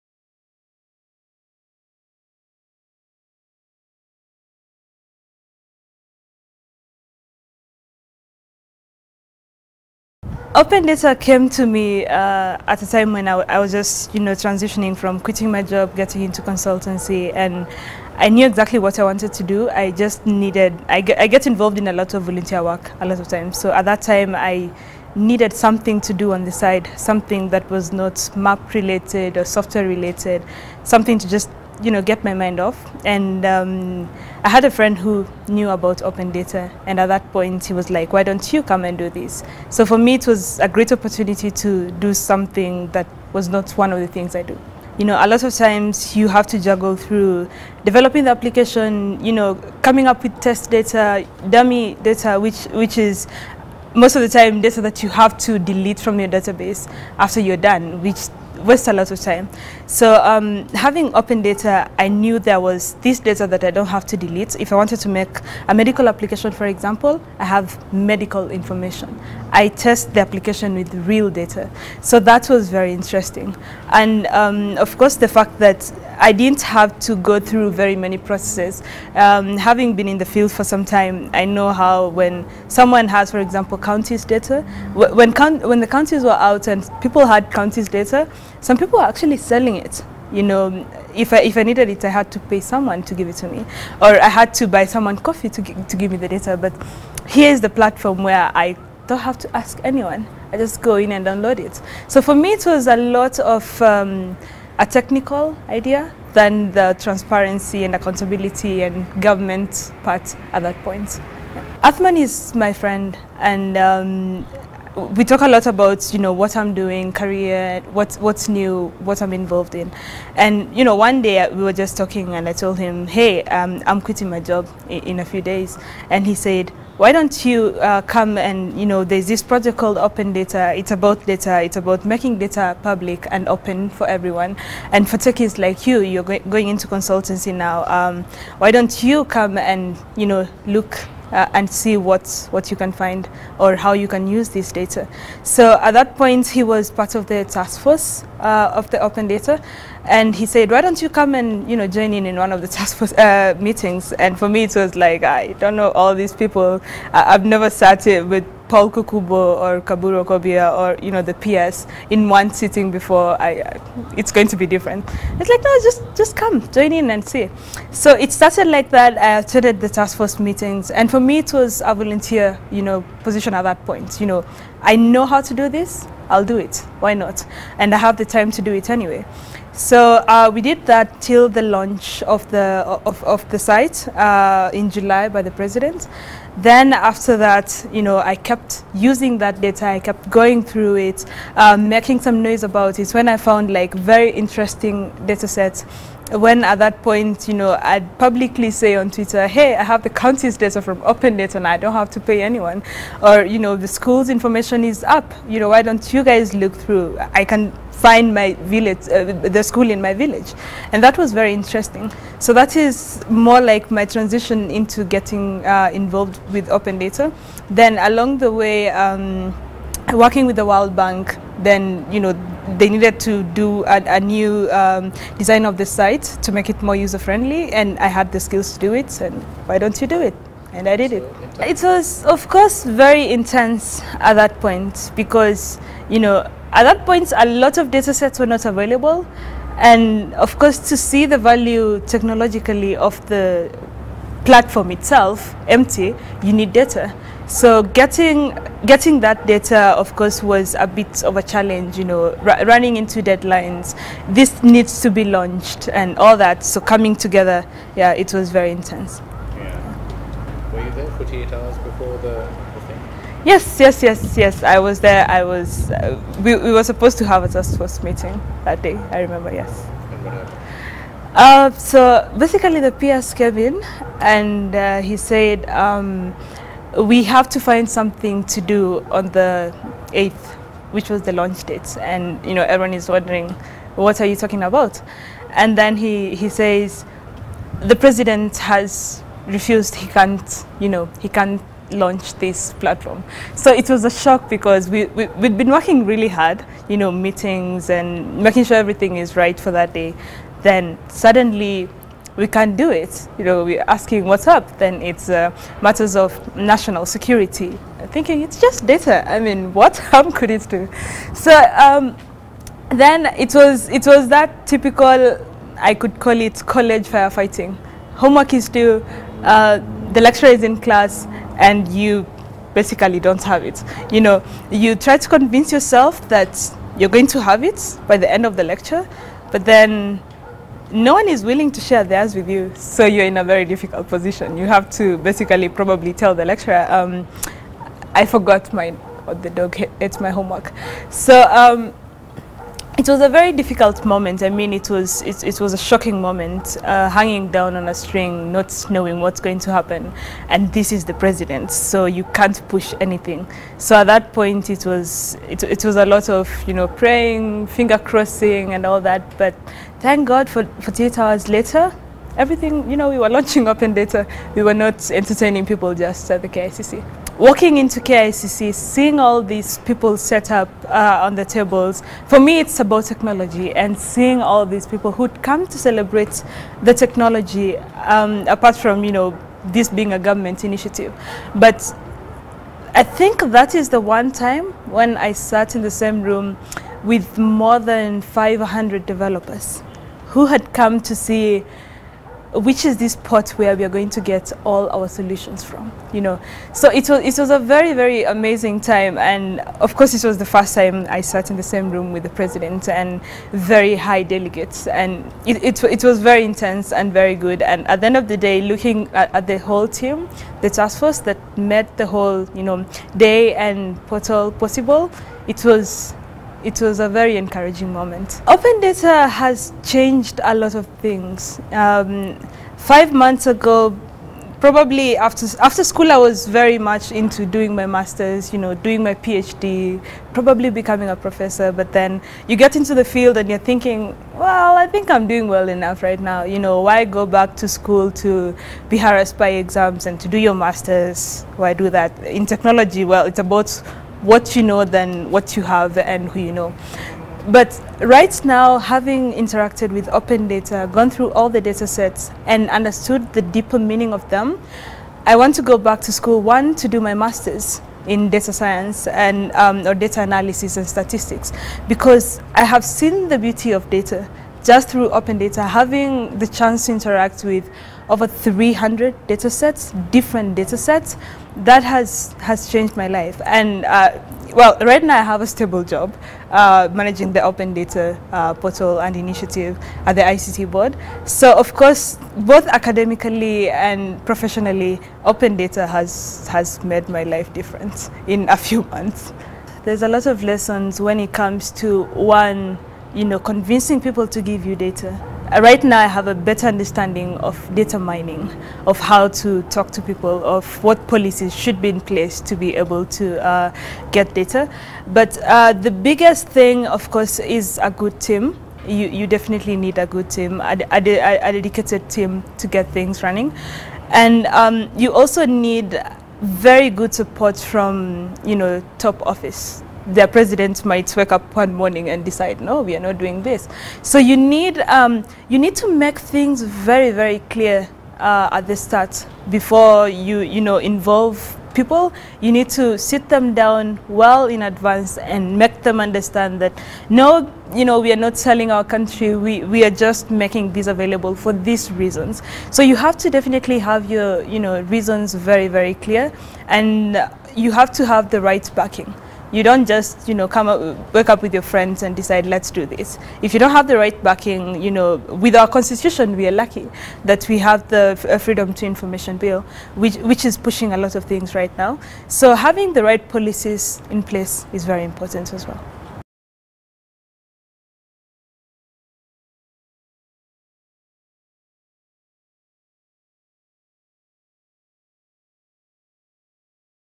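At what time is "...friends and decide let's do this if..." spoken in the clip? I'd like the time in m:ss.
9:11.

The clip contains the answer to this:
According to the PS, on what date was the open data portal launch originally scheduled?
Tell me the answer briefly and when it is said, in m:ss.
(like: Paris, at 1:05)
the 8th, at 4:39.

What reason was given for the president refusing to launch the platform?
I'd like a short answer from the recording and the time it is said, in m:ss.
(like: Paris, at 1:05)
National security, at 5:06.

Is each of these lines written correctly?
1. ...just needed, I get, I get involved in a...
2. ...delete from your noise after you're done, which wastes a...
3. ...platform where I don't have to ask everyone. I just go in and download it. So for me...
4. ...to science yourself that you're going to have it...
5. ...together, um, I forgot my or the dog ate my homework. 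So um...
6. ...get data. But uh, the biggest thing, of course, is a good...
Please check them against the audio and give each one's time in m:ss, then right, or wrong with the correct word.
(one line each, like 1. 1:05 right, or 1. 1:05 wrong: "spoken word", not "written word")
1. 0:19 right
2. 0:55 wrong: "database", not "noise"
3. 1:37 wrong: "anyone", not "everyone"
4. 5:25 wrong: "convince", not "science"
5. 5:36 wrong: "lecturer", not "together"
6. 8:24 right.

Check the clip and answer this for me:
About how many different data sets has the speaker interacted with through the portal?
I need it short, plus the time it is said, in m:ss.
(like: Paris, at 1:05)
Over 300, at 7:48.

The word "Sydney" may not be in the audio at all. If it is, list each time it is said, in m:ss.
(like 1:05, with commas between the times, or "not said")
not said.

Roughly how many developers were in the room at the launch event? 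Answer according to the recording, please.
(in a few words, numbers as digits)
More than 500.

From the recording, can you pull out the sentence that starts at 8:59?
We, we are just making this available for these reasons.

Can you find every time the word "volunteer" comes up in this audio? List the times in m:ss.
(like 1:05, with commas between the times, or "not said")
0:22, 2:51.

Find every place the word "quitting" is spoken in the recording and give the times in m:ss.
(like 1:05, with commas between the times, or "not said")
0:15, 2:04.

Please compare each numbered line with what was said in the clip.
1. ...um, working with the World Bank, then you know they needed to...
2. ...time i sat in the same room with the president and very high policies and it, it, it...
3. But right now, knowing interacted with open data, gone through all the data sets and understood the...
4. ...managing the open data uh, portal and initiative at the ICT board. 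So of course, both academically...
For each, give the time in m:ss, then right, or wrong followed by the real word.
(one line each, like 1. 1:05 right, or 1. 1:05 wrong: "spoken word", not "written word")
1. 3:38 right
2. 6:40 wrong: "delegates", not "policies"
3. 7:27 wrong: "having", not "knowing"
4. 7:56 right.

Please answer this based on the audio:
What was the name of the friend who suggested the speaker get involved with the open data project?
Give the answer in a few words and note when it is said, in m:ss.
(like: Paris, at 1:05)
Athman, at 1:51.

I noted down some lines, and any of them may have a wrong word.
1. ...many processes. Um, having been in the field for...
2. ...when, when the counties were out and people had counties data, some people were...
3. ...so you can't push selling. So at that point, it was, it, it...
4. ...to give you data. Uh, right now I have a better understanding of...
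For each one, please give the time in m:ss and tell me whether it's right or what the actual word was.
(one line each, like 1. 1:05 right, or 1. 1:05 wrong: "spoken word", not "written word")
1. 1:17 right
2. 1:24 right
3. 5:51 wrong: "anything", not "selling"
4. 8:14 right.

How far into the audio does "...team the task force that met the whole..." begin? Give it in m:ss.
6:49.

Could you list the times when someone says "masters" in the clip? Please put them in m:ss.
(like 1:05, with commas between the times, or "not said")
7:07, 7:20, 7:37.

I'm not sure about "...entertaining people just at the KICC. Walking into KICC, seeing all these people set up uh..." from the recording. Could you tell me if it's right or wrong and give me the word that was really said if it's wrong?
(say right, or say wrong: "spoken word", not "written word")
right.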